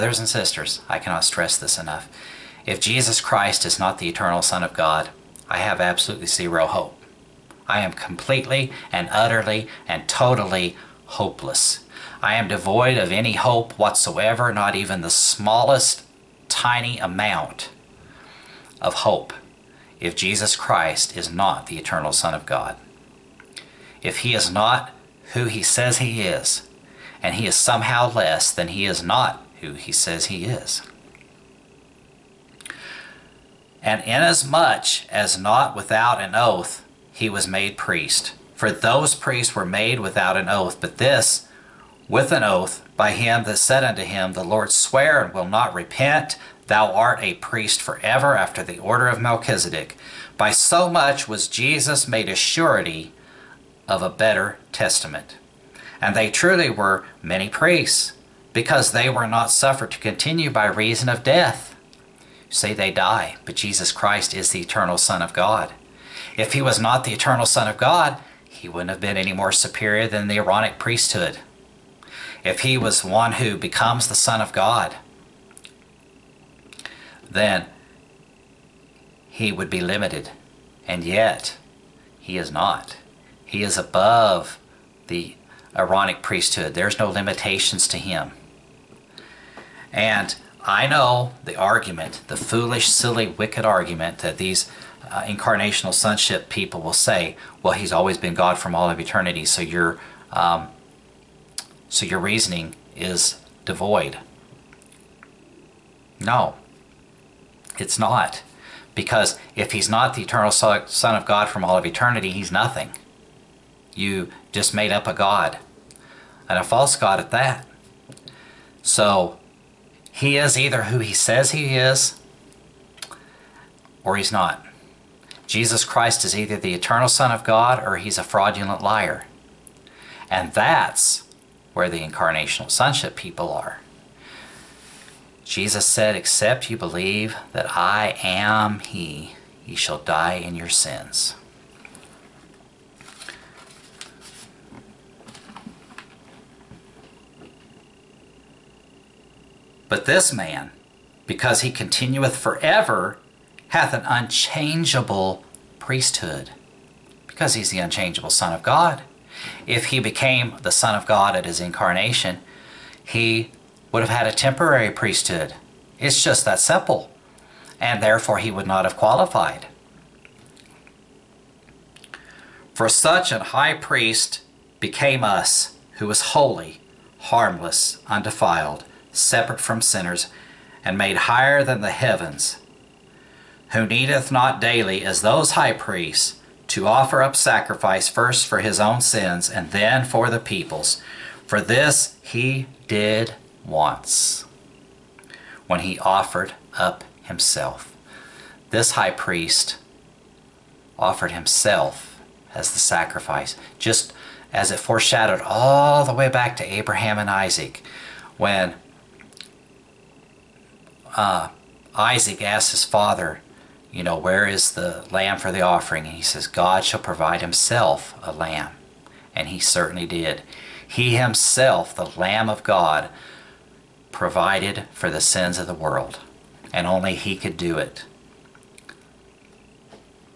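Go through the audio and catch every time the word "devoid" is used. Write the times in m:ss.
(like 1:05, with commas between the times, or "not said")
0:12, 1:43.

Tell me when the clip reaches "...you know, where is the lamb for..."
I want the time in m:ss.
3:33.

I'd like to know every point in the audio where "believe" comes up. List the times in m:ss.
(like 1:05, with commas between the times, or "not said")
2:16.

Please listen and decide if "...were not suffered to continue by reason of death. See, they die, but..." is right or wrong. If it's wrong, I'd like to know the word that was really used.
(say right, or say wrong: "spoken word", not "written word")
right.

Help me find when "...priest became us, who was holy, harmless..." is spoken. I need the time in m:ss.
2:53.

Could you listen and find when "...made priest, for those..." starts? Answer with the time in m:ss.
0:37.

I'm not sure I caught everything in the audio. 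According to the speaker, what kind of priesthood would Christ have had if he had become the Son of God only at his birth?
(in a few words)
temporary priesthood.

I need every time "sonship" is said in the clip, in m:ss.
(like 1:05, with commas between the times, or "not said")
1:35, 2:12.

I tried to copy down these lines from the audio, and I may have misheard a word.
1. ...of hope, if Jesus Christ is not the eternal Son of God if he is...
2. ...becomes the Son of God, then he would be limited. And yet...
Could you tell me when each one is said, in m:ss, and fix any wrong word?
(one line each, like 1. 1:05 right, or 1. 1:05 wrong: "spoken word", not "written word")
1. 0:18 right
2. 1:13 right.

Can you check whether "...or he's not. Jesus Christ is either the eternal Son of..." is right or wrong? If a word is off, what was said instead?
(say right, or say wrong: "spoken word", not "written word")
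right.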